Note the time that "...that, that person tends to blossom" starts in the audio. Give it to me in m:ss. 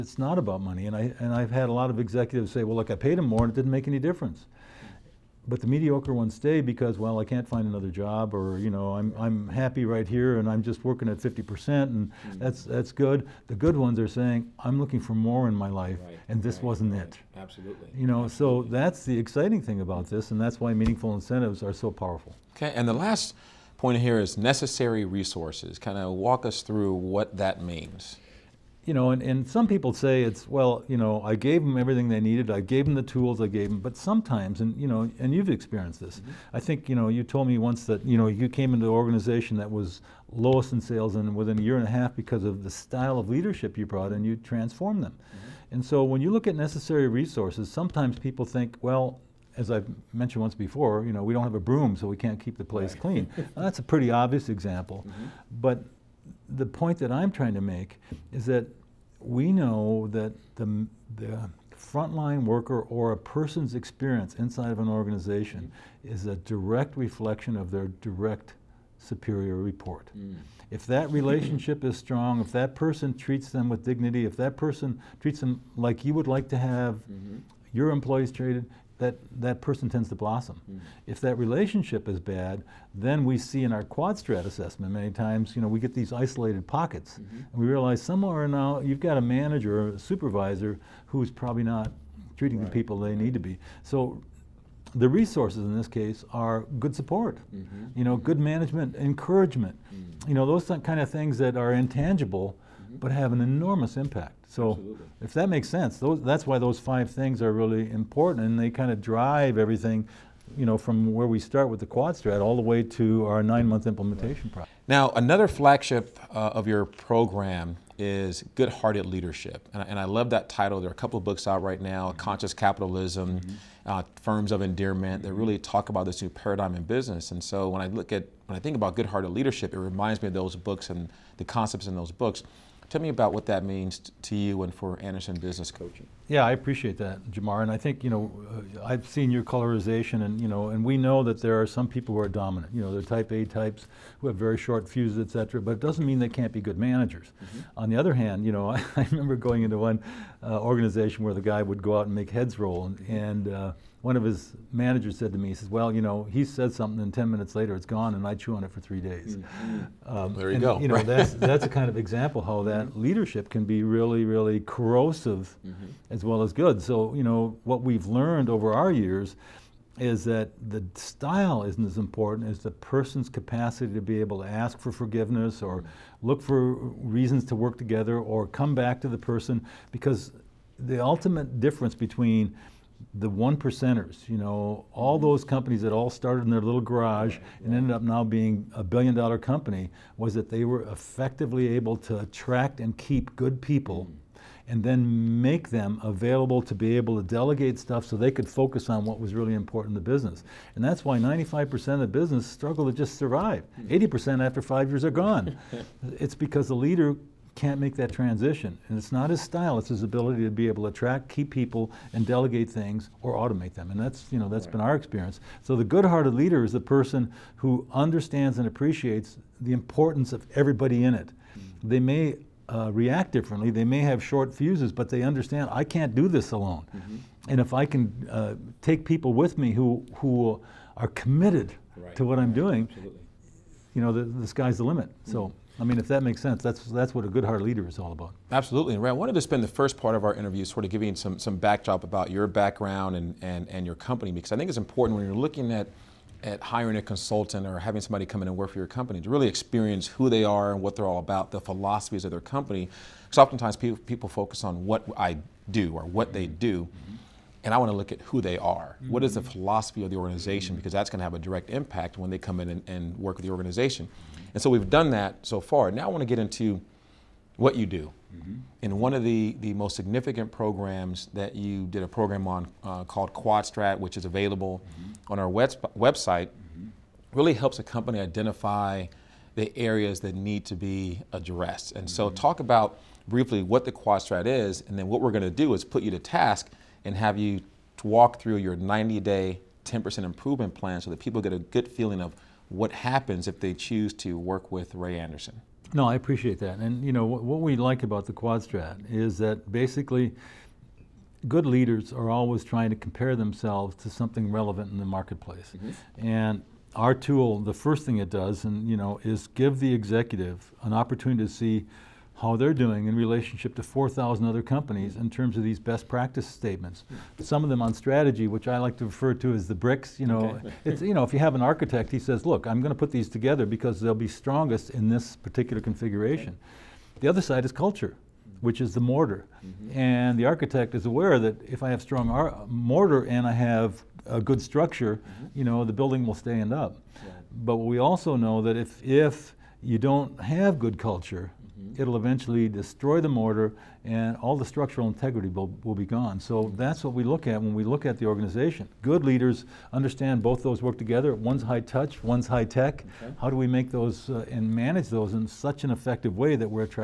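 1:19.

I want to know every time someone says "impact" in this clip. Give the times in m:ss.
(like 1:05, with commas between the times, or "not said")
1:43, 4:21.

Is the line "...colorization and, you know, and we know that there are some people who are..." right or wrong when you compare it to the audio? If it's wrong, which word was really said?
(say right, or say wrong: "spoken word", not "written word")
right.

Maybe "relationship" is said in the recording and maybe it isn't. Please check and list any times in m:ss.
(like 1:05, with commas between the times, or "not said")
1:11, 1:21, 5:13.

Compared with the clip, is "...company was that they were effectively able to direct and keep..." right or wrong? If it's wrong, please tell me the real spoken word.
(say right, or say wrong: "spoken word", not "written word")
wrong: "attract", not "direct".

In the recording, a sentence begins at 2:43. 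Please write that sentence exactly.
leadership can be really, really corrosive mm-hmm.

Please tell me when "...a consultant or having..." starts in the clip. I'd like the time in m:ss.
4:06.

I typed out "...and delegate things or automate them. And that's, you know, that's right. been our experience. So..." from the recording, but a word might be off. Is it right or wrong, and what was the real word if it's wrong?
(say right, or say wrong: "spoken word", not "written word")
right.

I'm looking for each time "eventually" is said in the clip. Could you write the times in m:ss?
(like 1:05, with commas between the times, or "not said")
5:42.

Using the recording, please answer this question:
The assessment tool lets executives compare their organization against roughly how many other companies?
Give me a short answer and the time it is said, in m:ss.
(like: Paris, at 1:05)
4,000, at 5:13.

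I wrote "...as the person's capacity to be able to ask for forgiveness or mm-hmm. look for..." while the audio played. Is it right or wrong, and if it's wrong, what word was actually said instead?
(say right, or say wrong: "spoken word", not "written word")
right.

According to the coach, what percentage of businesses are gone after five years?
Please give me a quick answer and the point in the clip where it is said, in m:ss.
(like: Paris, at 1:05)
80%, at 3:23.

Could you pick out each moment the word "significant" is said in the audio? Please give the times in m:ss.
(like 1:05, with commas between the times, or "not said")
4:29.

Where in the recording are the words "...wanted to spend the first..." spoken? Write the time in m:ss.
3:59.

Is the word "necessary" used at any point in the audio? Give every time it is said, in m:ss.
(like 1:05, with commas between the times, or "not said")
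0:24, 0:46.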